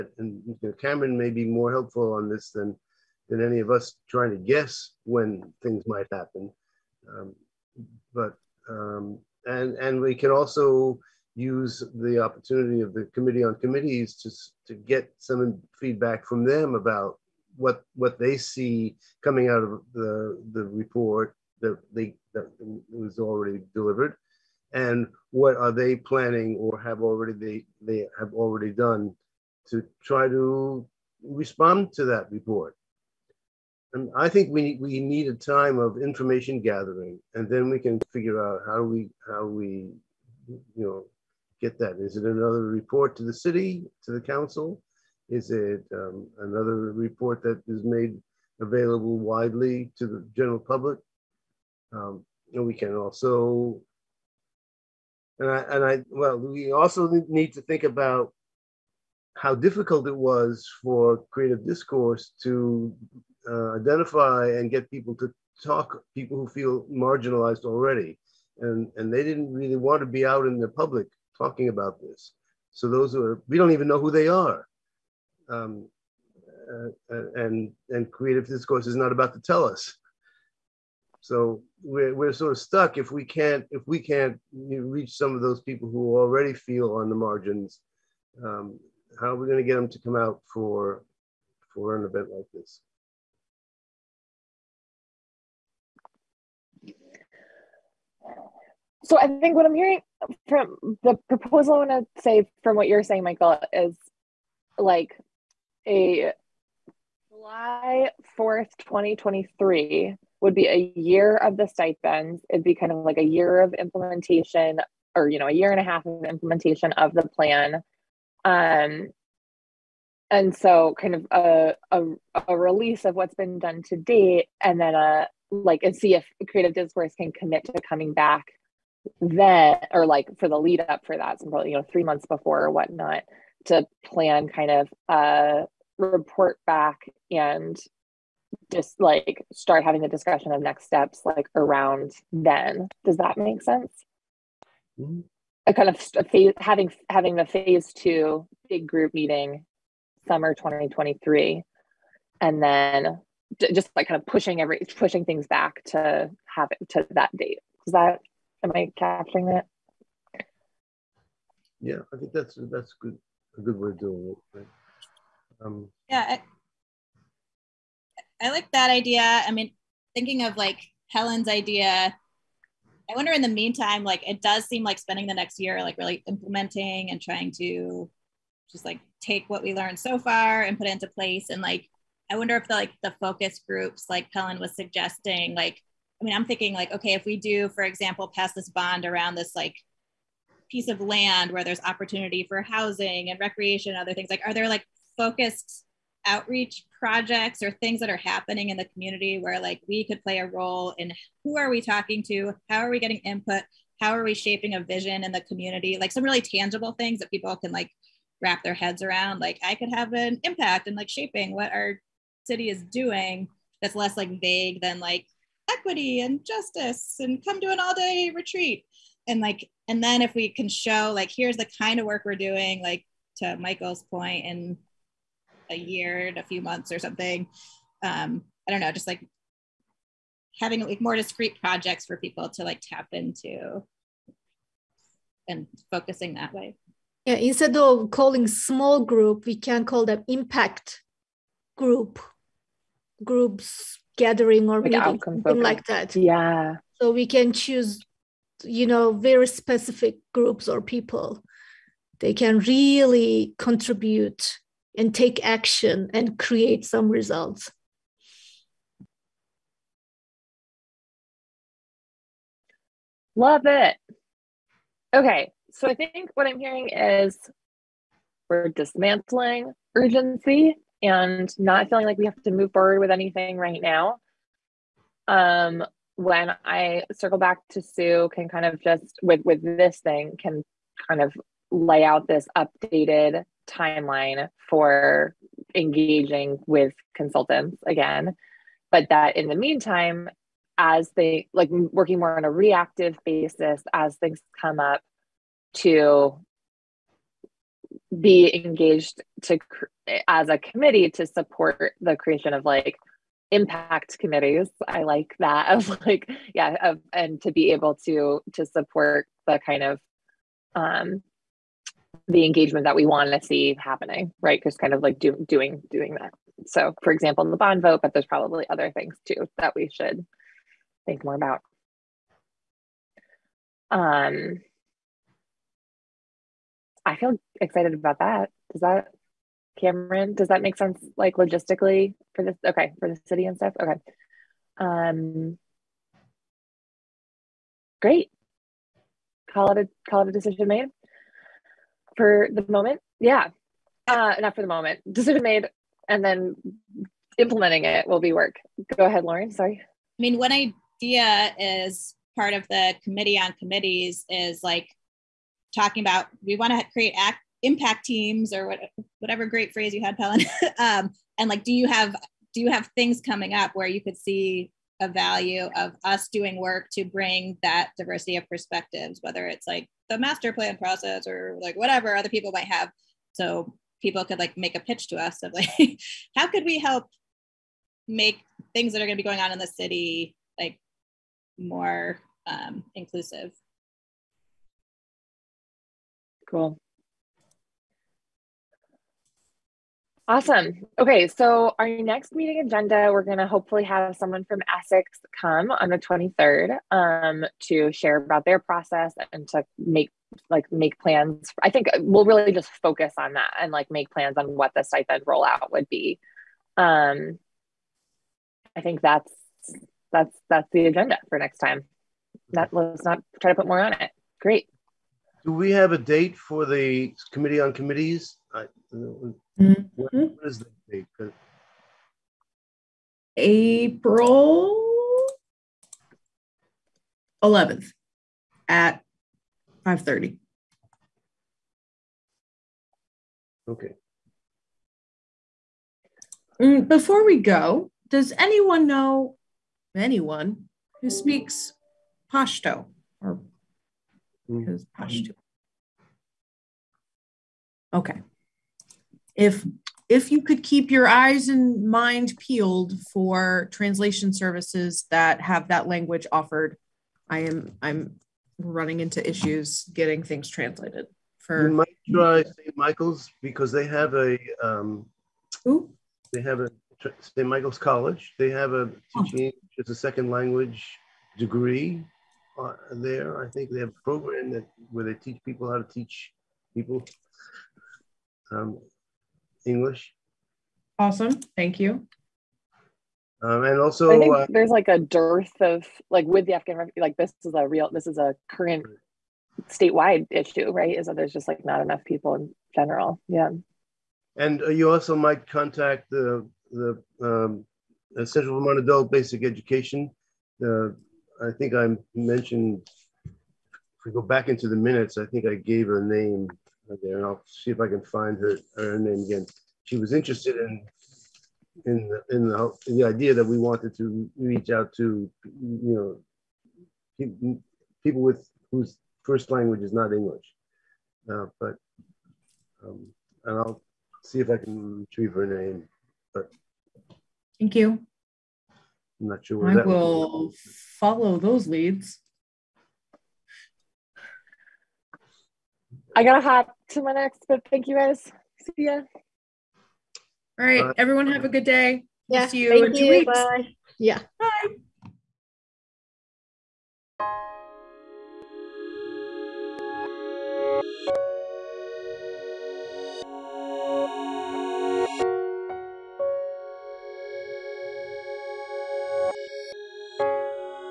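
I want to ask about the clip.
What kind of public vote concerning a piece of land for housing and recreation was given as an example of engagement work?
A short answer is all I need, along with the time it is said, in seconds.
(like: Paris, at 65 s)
Bond vote, at 317 s.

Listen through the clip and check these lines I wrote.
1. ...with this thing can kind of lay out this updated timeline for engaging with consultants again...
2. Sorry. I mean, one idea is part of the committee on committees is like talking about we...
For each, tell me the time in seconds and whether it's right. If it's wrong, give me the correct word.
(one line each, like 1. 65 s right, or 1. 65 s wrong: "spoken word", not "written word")
1. 279 s right
2. 349 s right.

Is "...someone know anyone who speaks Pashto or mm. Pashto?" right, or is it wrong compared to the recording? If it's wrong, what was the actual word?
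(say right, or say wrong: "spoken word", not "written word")
wrong: "anyone", not "someone".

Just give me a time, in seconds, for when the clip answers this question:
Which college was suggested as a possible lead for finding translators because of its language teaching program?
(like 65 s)
467 s.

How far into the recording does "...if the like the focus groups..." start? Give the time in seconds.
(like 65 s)
182 s.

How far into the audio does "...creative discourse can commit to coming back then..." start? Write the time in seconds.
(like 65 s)
126 s.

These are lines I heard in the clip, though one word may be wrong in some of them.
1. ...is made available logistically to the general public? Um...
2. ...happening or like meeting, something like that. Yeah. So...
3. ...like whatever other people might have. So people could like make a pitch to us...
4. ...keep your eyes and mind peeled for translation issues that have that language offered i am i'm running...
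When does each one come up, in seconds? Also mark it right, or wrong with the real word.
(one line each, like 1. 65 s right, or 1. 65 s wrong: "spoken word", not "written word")
1. 47 s wrong: "widely", not "logistically"
2. 244 s wrong: "gathering", not "happening"
3. 371 s right
4. 450 s wrong: "services", not "issues".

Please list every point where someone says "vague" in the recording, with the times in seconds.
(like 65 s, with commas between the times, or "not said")
214 s.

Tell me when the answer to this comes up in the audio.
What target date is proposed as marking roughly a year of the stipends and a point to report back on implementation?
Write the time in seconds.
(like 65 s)
107 s.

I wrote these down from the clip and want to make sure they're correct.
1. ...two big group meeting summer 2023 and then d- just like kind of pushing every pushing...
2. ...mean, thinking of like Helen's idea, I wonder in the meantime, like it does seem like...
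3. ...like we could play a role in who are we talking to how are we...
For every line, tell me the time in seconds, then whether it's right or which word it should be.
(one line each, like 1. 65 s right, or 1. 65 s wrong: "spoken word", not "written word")
1. 147 s right
2. 169 s right
3. 199 s right.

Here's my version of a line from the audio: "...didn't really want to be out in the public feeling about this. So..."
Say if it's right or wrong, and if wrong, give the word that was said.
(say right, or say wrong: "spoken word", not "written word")
wrong: "talking", not "feeling".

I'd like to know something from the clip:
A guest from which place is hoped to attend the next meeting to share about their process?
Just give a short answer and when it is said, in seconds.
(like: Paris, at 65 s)
Essex, at 394 s.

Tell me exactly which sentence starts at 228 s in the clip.
Um, I don't know, just like having like more discrete projects for people to like tap into and focusing that way.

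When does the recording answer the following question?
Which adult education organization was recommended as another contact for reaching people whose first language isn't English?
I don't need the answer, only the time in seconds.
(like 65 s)
498 s.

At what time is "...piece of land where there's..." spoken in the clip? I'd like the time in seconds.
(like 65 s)
190 s.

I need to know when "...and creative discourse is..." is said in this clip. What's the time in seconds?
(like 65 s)
77 s.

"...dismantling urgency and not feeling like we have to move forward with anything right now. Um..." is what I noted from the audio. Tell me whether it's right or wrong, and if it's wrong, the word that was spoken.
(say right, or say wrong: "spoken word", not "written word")
right.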